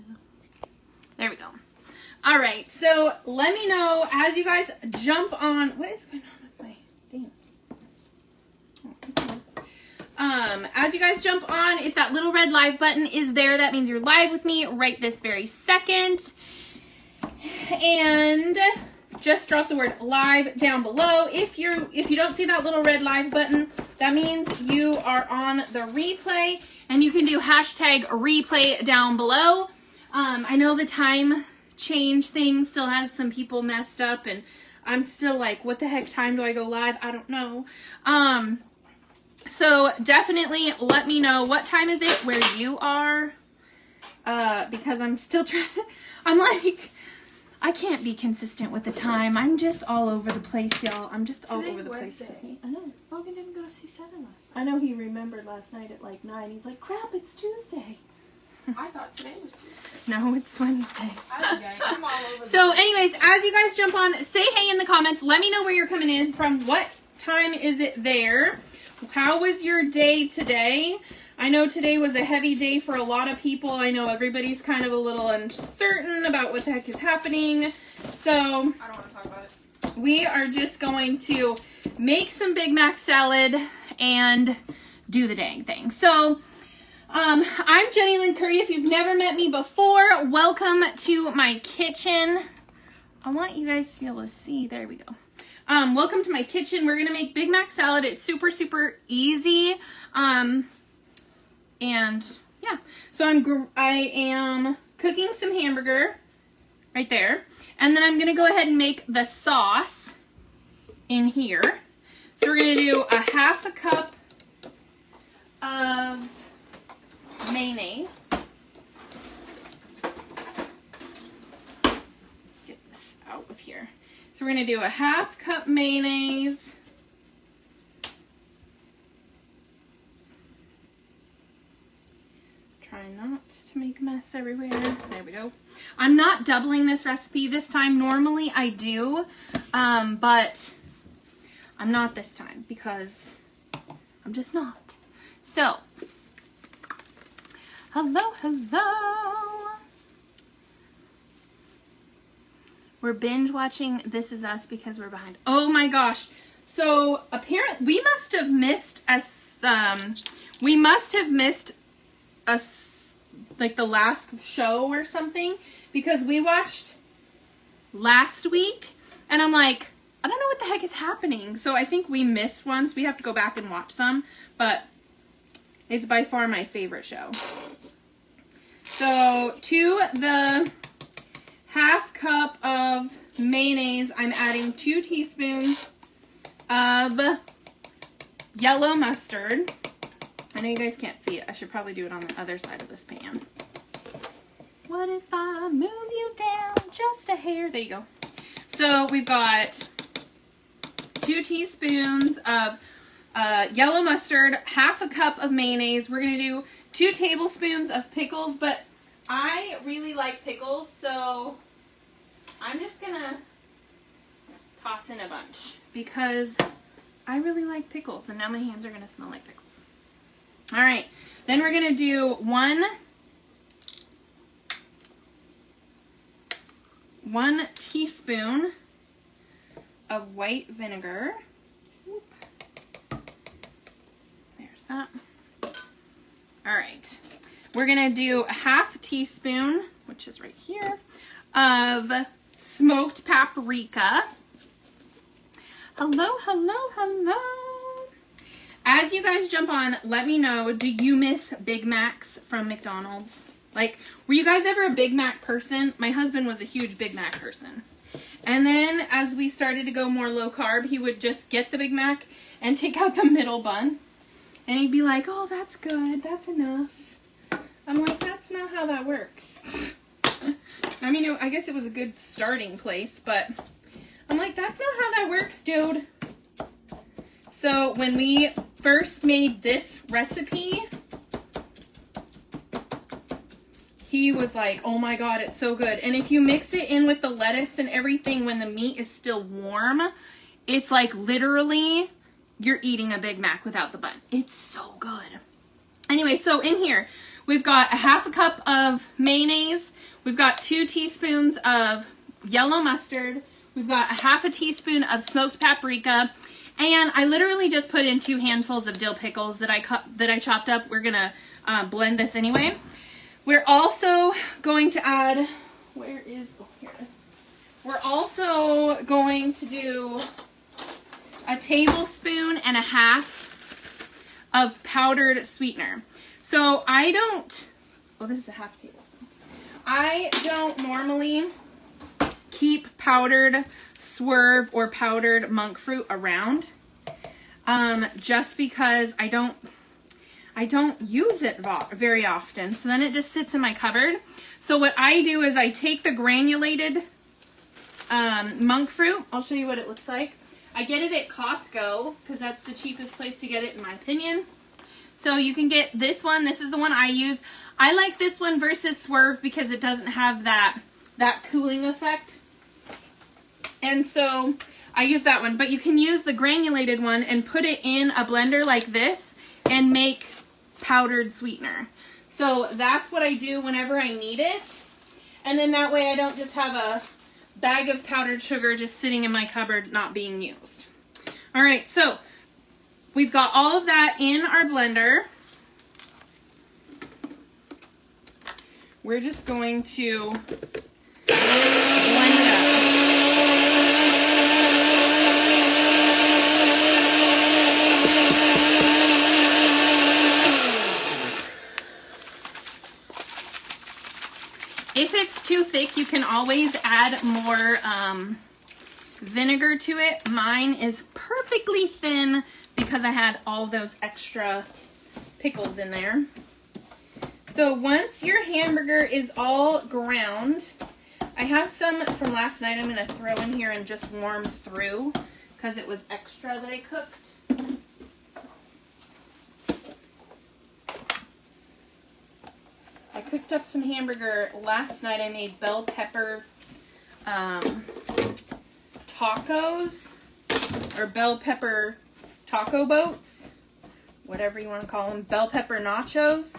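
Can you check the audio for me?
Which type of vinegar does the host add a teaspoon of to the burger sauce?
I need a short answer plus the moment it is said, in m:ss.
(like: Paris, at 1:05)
white vinegar, at 3:50.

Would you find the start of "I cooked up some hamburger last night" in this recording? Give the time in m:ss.
7:13.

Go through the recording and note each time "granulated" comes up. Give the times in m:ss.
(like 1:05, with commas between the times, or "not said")
5:46, 6:06.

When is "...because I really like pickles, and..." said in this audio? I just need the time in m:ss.
3:35.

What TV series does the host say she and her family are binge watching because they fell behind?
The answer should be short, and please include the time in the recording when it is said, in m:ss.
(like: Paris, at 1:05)
This Is Us, at 2:34.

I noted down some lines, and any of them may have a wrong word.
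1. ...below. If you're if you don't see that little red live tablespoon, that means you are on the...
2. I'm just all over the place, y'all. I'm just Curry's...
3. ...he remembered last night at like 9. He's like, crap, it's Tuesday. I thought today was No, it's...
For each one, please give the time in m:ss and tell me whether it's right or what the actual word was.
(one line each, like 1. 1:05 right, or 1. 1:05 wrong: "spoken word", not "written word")
1. 0:20 wrong: "button", not "tablespoon"
2. 0:49 wrong: "Today", not "Curry"
3. 0:54 right.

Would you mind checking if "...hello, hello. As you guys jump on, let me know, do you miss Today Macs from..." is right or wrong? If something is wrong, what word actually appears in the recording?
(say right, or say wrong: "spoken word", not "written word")
wrong: "Big", not "Today".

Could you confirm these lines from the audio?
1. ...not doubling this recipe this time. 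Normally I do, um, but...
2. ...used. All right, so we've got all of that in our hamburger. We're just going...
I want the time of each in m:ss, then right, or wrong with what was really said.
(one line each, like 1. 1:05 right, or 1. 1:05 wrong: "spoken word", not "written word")
1. 2:16 right
2. 6:20 wrong: "blender", not "hamburger".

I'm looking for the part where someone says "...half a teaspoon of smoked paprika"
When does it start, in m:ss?
5:04.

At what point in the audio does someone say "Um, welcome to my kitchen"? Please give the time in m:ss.
1:35.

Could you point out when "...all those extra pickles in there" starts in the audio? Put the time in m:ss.
6:53.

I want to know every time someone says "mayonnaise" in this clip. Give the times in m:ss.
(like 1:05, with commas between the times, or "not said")
1:57, 2:05, 3:03, 3:25, 4:59.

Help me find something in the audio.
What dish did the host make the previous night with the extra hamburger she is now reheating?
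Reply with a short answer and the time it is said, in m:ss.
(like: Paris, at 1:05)
bell pepper taco boats, at 7:21.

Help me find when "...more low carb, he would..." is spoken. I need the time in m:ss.
4:20.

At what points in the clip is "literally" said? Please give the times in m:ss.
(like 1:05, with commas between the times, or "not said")
4:51, 5:07.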